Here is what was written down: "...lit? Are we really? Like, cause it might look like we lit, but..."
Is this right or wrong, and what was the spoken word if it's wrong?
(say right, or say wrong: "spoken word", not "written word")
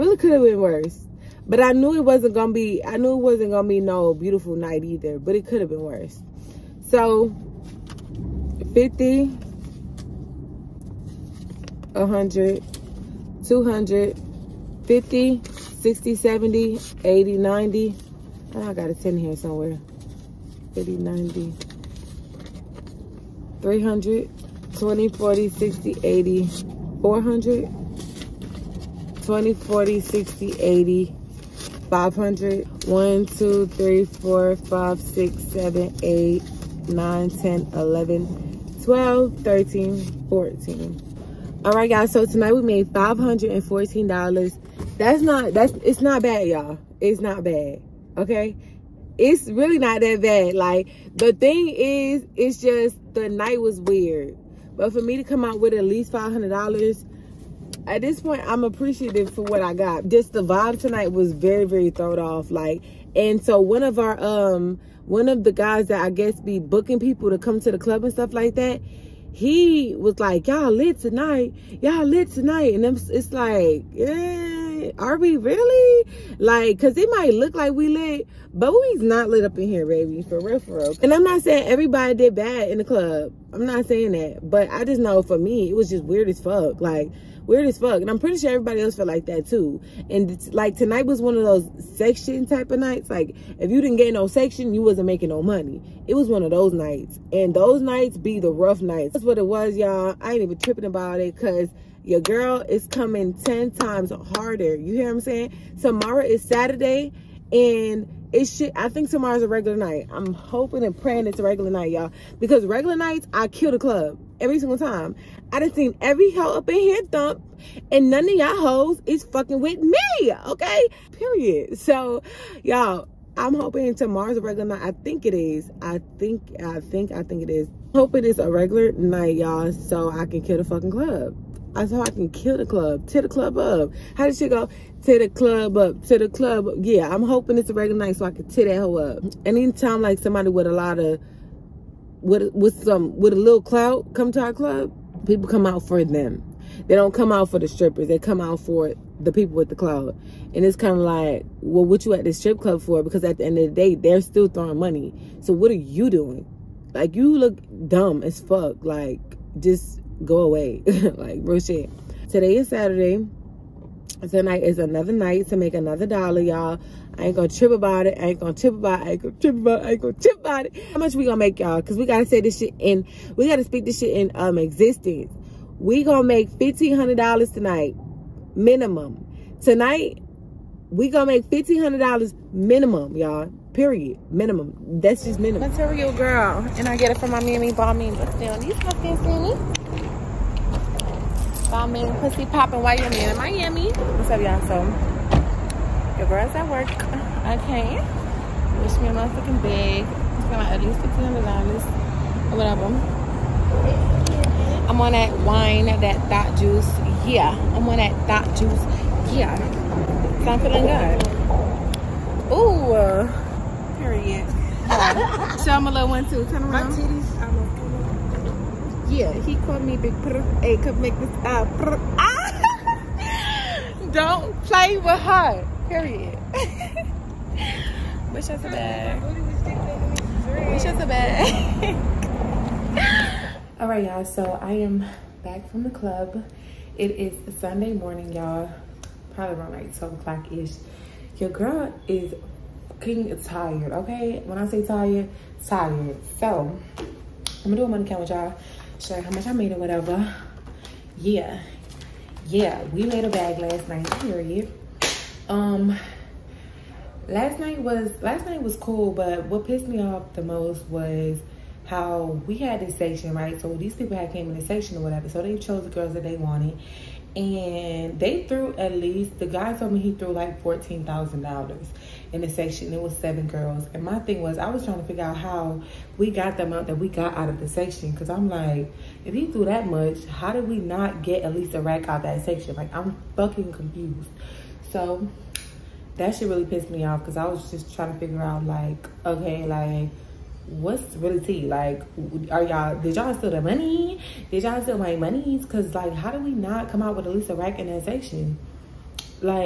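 right.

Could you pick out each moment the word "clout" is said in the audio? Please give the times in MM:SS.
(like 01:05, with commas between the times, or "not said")
02:23, 02:29.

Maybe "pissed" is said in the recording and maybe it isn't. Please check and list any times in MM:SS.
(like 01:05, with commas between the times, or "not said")
04:19, 04:46.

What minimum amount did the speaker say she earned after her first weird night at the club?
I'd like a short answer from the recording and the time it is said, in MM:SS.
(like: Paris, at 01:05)
$500, at 00:56.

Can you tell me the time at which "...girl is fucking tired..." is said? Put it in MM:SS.
04:01.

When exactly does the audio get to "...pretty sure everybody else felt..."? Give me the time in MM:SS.
01:28.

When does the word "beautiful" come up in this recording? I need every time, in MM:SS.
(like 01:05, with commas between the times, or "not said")
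00:04.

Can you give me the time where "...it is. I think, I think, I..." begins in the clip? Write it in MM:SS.
02:05.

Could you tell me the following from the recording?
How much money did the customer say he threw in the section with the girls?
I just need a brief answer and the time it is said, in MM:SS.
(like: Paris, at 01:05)
$14,000, at 04:30.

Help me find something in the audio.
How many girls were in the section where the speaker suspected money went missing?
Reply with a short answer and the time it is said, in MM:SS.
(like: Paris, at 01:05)
7, at 04:33.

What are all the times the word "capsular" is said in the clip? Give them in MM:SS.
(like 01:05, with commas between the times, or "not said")
not said.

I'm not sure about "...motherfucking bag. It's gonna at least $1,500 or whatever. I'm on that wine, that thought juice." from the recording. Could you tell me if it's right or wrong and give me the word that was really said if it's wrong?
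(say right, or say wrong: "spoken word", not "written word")
right.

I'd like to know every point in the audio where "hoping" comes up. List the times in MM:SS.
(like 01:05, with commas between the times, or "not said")
01:50, 02:03, 02:17.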